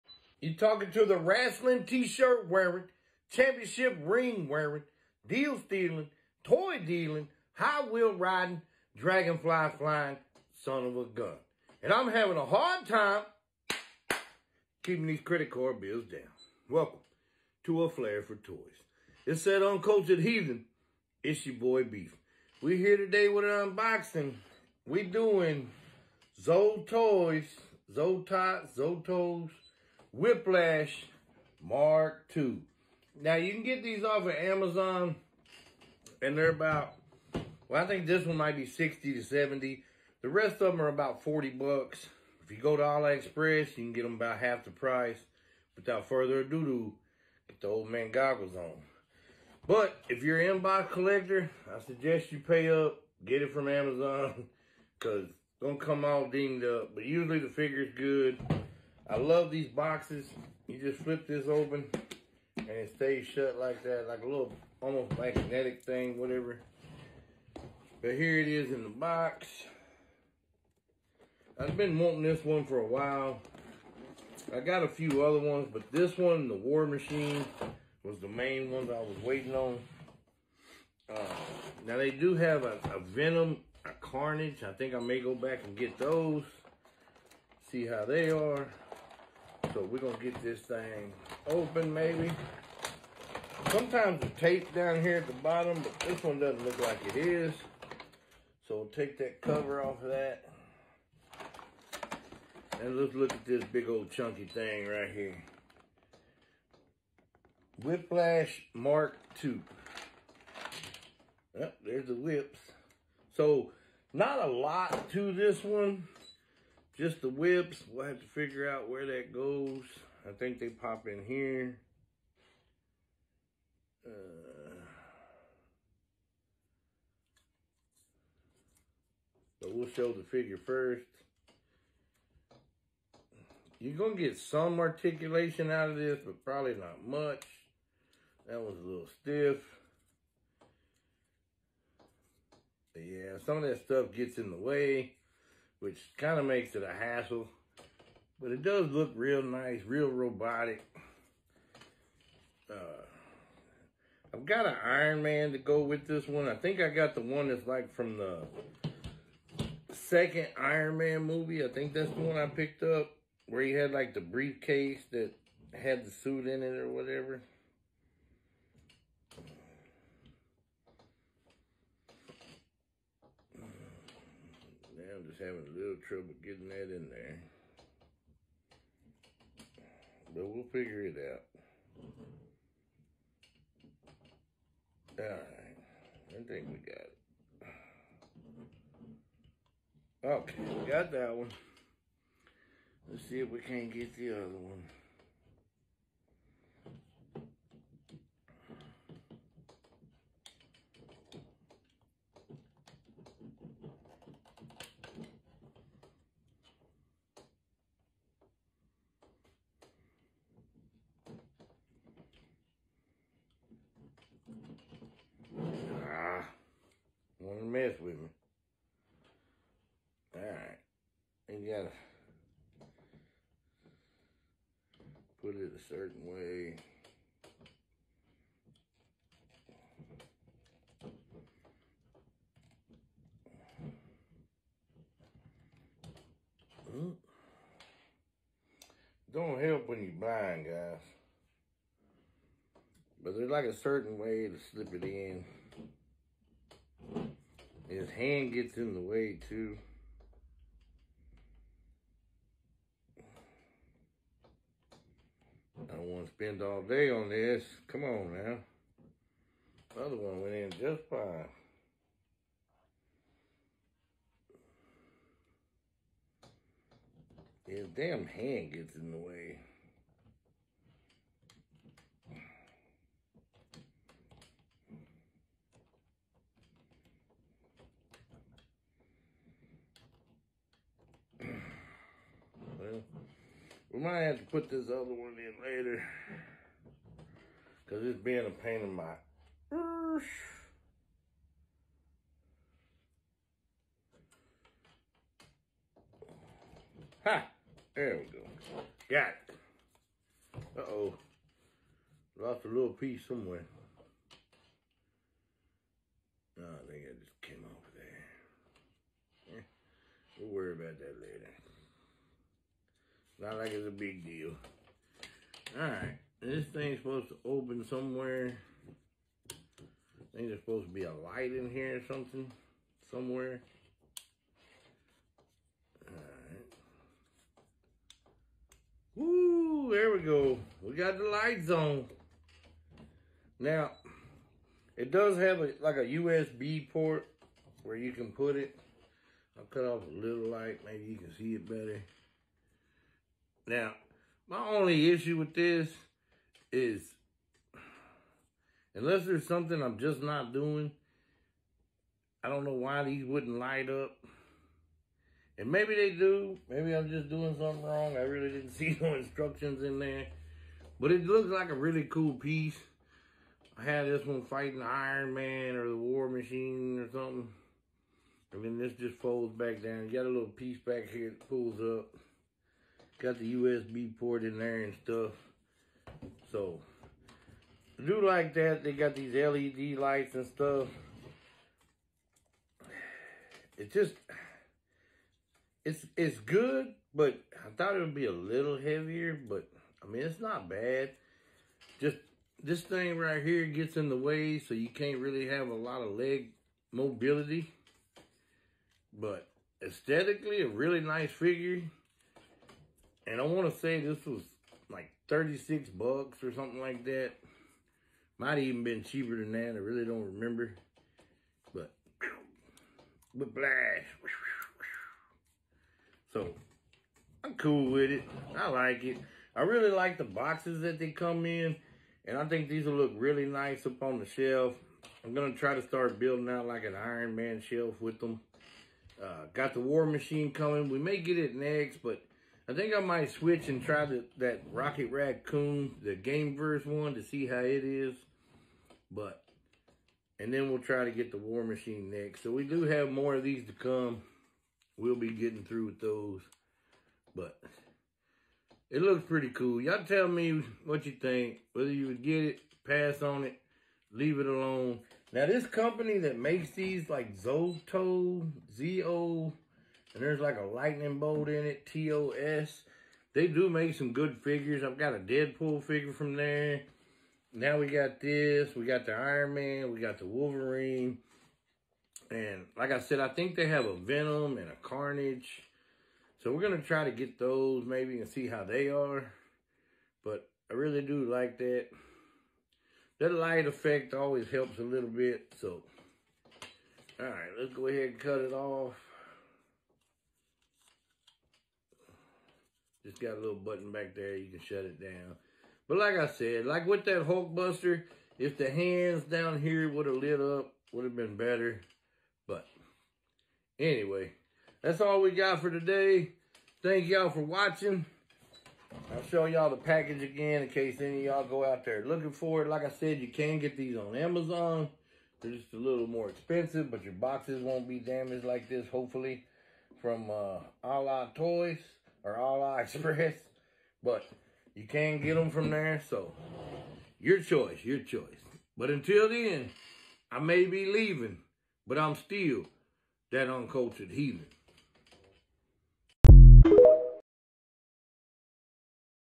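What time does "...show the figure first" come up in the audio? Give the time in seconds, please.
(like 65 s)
129 s.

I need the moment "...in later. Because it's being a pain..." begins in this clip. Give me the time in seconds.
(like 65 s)
285 s.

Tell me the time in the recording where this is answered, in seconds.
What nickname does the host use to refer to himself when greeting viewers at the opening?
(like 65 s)
21 s.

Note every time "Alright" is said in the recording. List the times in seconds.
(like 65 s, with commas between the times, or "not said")
185 s, 315 s, 326 s.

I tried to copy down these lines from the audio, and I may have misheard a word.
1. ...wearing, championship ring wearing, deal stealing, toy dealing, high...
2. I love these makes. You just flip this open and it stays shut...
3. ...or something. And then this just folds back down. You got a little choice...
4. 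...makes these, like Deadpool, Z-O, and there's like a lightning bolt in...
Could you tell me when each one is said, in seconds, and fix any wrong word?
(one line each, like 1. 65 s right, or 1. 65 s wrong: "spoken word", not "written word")
1. 2 s right
2. 59 s wrong: "boxes", not "makes"
3. 366 s wrong: "piece", not "choice"
4. 456 s wrong: "Zoto", not "Deadpool".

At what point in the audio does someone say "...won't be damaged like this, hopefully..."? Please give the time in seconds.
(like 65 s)
517 s.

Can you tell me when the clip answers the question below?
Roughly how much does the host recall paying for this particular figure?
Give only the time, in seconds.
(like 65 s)
405 s.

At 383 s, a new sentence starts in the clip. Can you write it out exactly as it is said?
It's just, it's, it's good, but I thought it would be a little heavier, but I mean, it's not bad.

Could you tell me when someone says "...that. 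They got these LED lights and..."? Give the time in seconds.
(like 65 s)
378 s.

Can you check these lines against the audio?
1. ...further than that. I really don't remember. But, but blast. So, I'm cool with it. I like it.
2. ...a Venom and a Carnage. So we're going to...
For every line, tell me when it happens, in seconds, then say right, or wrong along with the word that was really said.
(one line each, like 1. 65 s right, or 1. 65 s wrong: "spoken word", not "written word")
1. 409 s wrong: "cheaper", not "further"
2. 473 s right.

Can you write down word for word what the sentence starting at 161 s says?
I think that's the one I picked up where he had like the briefcase that had the suit in it or whatever.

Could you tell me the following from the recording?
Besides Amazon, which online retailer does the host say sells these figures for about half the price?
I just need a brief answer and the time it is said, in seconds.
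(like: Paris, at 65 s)
AliExpress, at 42 s.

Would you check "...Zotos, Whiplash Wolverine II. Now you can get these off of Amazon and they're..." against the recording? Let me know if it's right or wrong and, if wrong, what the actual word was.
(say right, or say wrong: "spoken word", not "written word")
wrong: "Mark", not "Wolverine".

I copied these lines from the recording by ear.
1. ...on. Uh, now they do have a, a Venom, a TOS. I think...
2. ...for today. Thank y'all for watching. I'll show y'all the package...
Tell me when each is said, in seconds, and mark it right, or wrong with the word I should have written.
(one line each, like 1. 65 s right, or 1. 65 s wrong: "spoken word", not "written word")
1. 79 s wrong: "Carnage", not "TOS"
2. 505 s right.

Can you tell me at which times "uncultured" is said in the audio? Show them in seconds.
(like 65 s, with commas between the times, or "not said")
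19 s, 533 s.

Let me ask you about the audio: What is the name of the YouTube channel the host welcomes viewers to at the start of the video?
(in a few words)
A Flair for Toys.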